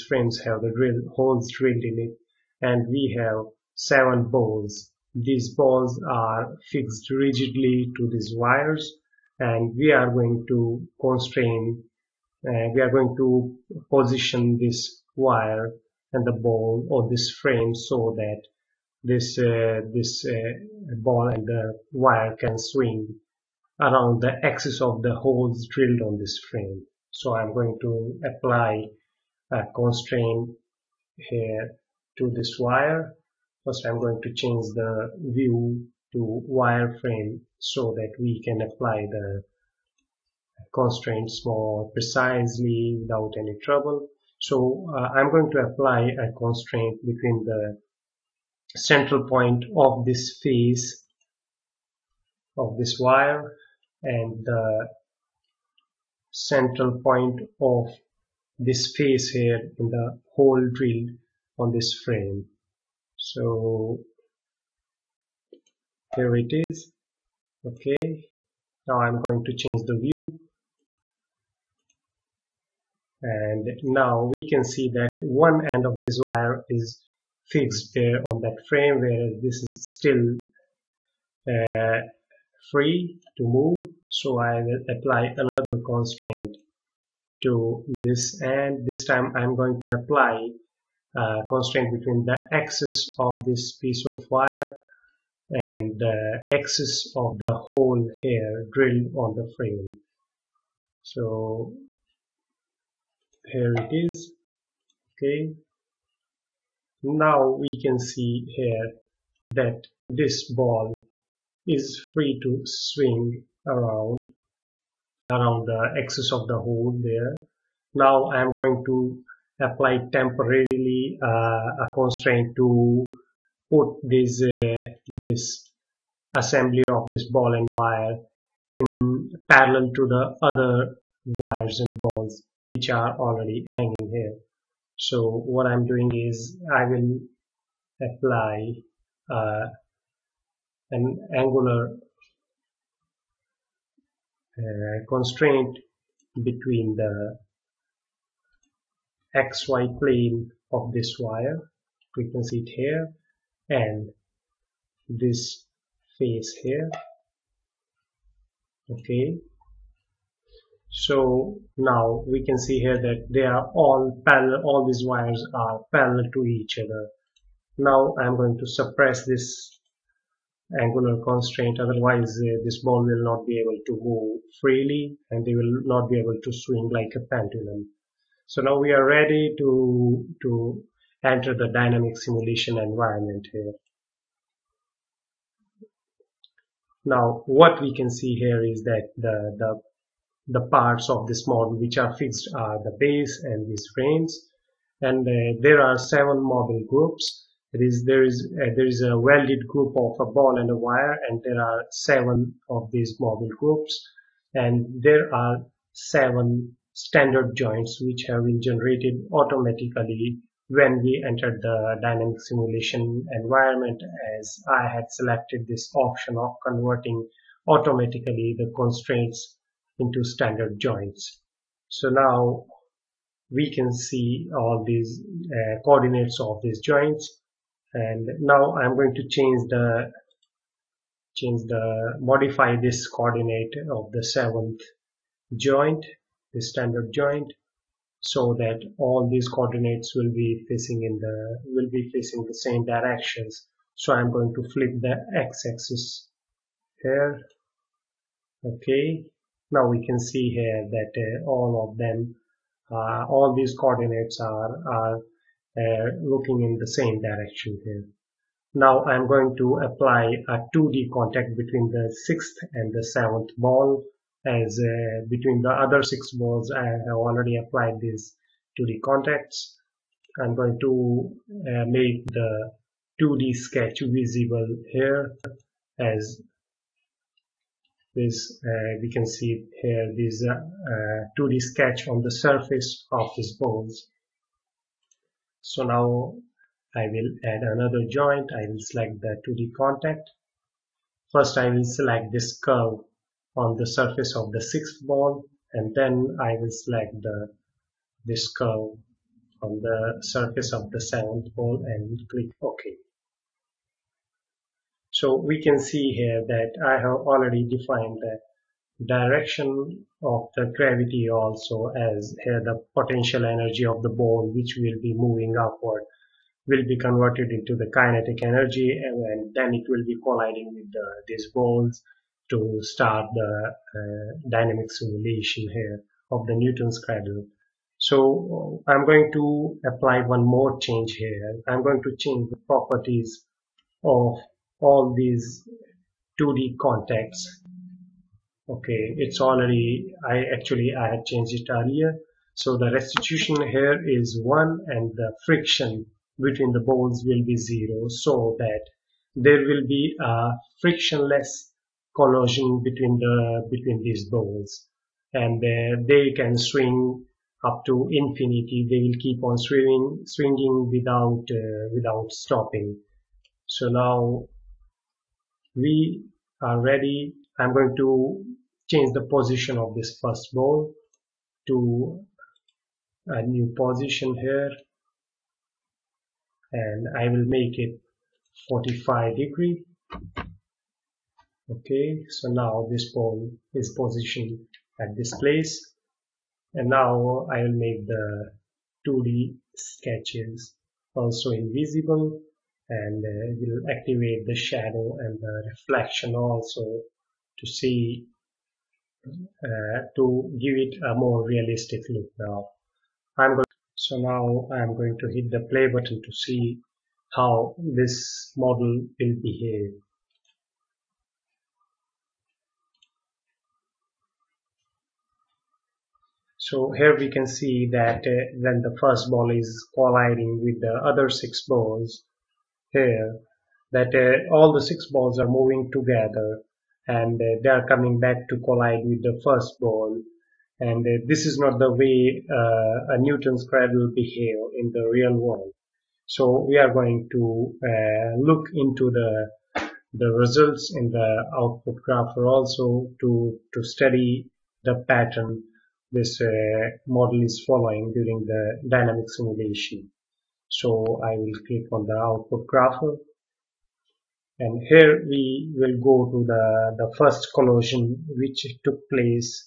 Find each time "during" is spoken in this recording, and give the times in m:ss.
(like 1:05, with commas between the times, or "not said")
7:28.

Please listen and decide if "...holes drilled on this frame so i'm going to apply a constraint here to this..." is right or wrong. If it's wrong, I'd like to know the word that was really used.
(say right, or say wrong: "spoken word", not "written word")
right.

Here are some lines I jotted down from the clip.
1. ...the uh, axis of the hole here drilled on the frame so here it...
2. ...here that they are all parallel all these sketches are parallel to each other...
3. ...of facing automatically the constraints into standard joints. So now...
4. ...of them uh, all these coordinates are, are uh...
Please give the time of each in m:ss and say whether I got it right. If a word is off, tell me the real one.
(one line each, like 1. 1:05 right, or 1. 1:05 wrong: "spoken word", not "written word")
1. 1:35 right
2. 2:42 wrong: "wires", not "sketches"
3. 3:36 wrong: "converting", not "facing"
4. 4:11 right.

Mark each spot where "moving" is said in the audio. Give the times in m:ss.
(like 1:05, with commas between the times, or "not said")
5:15, 7:05.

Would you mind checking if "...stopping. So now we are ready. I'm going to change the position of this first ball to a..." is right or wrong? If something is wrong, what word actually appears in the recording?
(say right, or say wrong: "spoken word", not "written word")
right.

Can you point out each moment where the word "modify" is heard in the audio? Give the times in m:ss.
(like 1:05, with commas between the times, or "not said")
3:52.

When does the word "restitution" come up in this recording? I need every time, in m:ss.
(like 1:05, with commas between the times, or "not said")
5:42.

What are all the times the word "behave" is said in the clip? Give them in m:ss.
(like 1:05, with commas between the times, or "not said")
6:49, 7:14.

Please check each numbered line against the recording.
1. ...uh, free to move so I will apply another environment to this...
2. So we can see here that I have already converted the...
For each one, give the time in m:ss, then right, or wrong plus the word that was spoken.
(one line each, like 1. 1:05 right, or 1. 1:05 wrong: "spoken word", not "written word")
1. 1:21 wrong: "constraint", not "environment"
2. 5:05 wrong: "defined", not "converted".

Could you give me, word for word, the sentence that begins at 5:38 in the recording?
Okay, it's already, I actually, I had changed it earlier.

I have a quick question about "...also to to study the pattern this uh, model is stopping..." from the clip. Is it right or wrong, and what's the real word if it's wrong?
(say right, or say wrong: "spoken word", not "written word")
wrong: "following", not "stopping".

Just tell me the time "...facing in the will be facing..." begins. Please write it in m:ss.
4:00.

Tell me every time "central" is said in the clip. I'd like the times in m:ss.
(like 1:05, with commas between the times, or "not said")
0:48, 0:56.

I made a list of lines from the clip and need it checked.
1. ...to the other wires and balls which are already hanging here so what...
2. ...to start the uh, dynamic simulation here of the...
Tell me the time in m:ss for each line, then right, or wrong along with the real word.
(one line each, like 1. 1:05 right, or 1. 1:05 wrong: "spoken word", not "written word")
1. 2:09 right
2. 5:22 right.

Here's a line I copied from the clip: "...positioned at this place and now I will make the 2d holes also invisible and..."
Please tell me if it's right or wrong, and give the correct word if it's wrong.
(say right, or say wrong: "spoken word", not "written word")
wrong: "sketches", not "holes".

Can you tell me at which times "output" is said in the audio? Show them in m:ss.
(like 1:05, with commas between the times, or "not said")
7:21, 7:32.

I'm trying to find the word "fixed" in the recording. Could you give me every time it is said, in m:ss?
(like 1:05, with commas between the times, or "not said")
0:06, 1:17, 3:12.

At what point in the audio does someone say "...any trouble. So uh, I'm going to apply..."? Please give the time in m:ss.
0:43.